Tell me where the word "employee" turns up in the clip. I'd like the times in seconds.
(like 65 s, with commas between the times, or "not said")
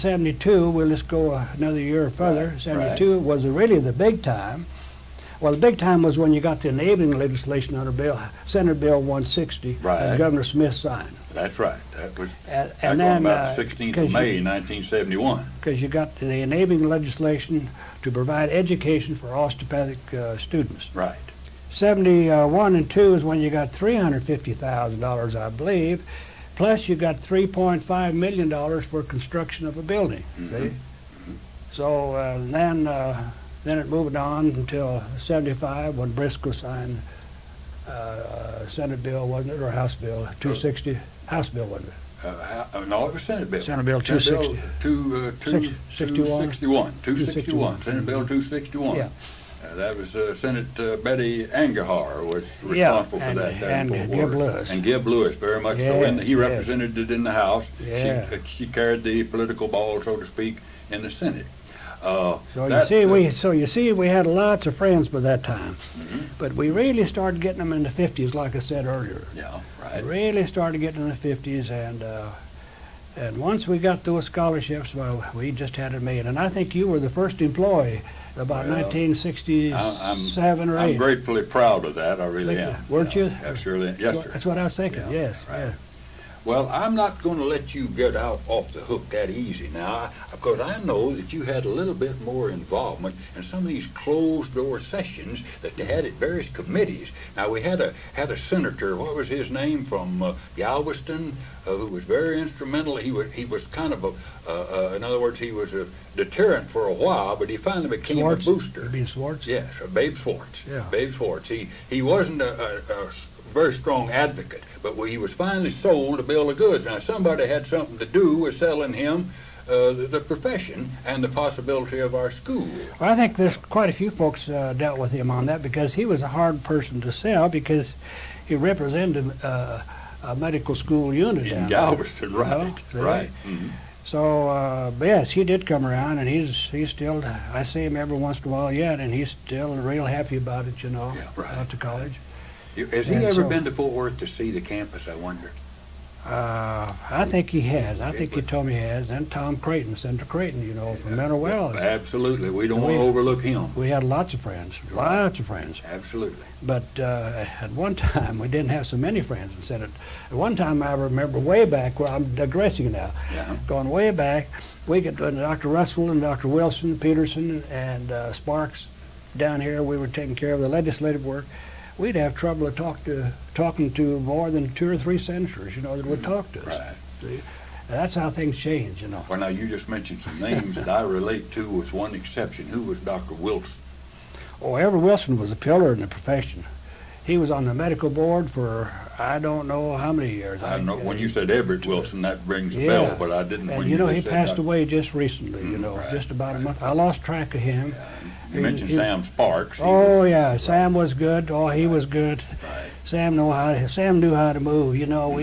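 77 s.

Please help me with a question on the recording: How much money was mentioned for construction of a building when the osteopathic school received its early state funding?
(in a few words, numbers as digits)
$3.5 million.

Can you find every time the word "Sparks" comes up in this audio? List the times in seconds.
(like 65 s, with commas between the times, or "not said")
168 s, 199 s.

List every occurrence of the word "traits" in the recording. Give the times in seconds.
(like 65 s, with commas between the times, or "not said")
not said.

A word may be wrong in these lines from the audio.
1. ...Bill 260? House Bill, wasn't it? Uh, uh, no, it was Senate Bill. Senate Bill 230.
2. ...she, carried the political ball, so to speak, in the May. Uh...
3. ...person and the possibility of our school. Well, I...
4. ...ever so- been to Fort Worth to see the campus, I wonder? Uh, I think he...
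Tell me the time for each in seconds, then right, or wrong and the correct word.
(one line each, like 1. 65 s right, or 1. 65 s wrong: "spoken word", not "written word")
1. 39 s wrong: "260", not "230"
2. 58 s wrong: "Senate", not "May"
3. 120 s wrong: "profession", not "person"
4. 143 s right.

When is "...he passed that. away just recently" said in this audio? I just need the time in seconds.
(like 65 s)
194 s.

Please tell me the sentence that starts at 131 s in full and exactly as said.
In Galveston, there, right, you know, right.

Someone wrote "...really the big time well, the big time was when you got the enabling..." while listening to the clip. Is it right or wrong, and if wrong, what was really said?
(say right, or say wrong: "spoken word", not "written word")
right.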